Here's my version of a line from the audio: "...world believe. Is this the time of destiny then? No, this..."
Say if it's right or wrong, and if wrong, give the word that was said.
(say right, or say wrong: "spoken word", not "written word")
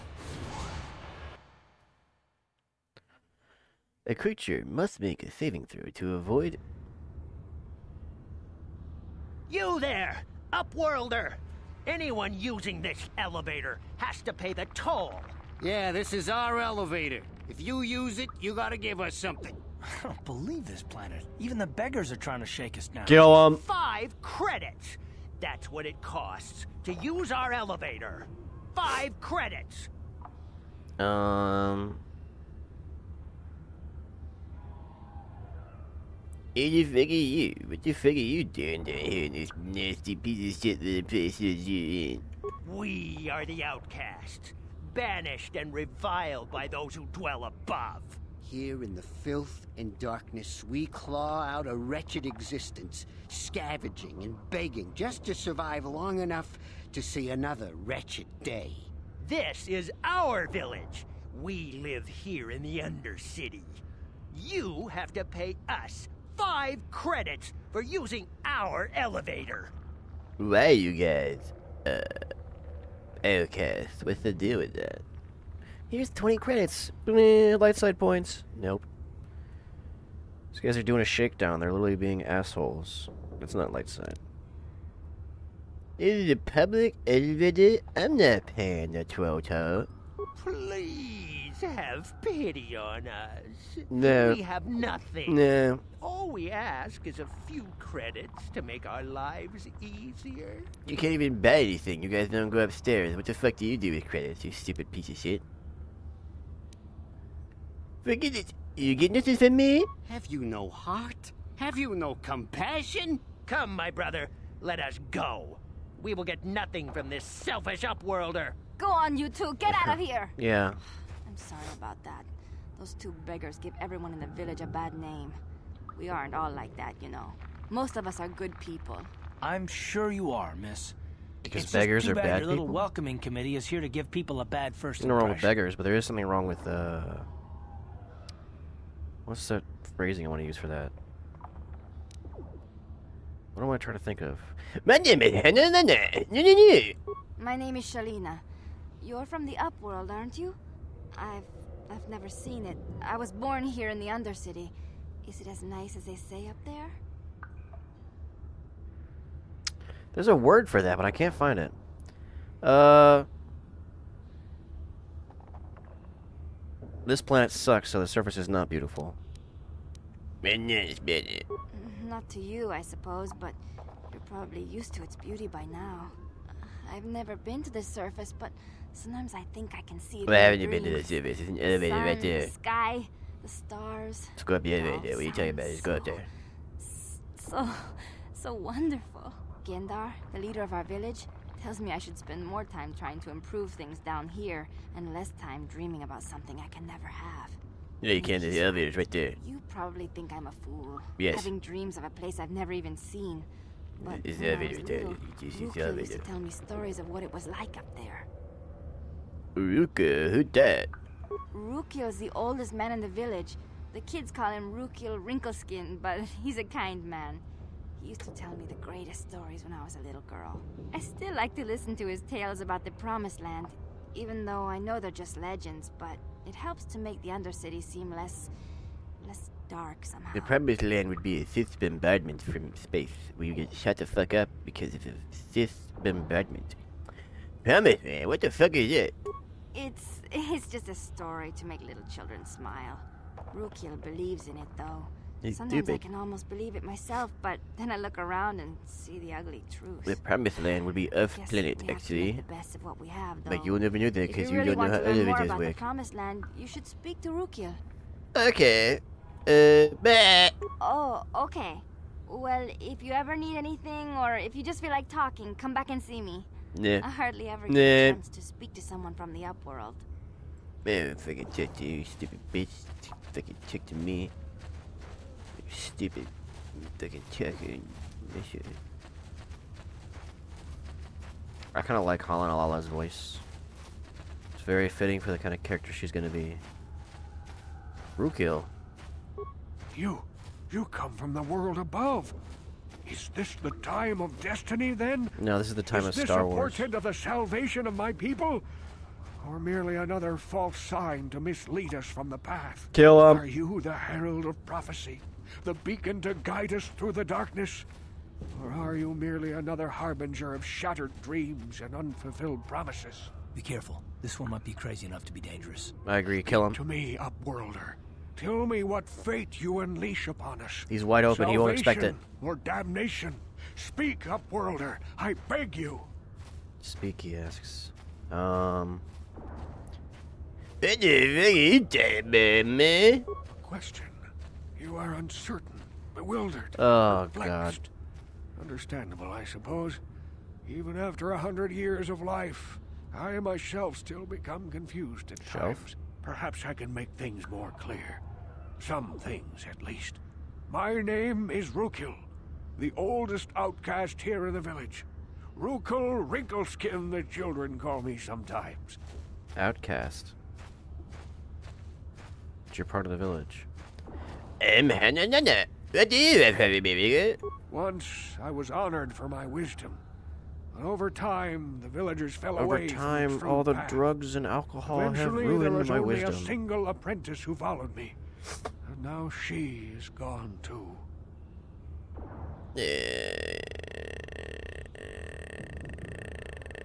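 wrong: "above", not "believe".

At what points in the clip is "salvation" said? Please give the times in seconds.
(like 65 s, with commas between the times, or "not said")
297 s, 321 s.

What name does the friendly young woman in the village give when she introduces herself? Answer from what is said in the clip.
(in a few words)
Shaleena.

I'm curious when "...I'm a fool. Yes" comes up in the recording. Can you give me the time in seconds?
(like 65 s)
200 s.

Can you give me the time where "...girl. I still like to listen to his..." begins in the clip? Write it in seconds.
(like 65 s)
220 s.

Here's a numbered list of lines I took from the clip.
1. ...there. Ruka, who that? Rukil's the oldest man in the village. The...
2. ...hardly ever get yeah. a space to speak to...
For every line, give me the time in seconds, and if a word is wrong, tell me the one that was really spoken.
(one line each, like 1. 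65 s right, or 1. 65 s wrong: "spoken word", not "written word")
1. 207 s right
2. 267 s wrong: "chance", not "space".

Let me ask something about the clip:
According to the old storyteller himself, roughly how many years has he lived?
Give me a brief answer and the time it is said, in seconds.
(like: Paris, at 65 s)
100, at 341 s.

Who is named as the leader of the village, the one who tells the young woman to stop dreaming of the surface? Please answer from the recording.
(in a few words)
Gendar.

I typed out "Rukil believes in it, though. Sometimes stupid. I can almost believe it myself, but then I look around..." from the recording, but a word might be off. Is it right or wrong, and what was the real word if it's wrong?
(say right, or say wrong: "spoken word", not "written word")
right.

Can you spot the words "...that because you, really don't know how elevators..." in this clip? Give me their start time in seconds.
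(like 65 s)
254 s.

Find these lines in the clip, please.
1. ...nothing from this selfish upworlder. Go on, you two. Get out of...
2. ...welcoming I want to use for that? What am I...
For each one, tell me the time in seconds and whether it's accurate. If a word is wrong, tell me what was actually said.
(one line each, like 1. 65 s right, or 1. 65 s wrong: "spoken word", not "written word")
1. 116 s right
2. 139 s wrong: "phrasing", not "welcoming".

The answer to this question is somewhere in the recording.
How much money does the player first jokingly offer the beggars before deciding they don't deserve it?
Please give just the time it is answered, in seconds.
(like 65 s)
76 s.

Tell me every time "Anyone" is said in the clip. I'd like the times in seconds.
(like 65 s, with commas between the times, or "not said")
11 s.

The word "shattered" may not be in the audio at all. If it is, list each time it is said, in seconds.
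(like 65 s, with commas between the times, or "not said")
310 s.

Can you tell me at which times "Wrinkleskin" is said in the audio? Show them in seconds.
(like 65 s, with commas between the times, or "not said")
215 s, 356 s.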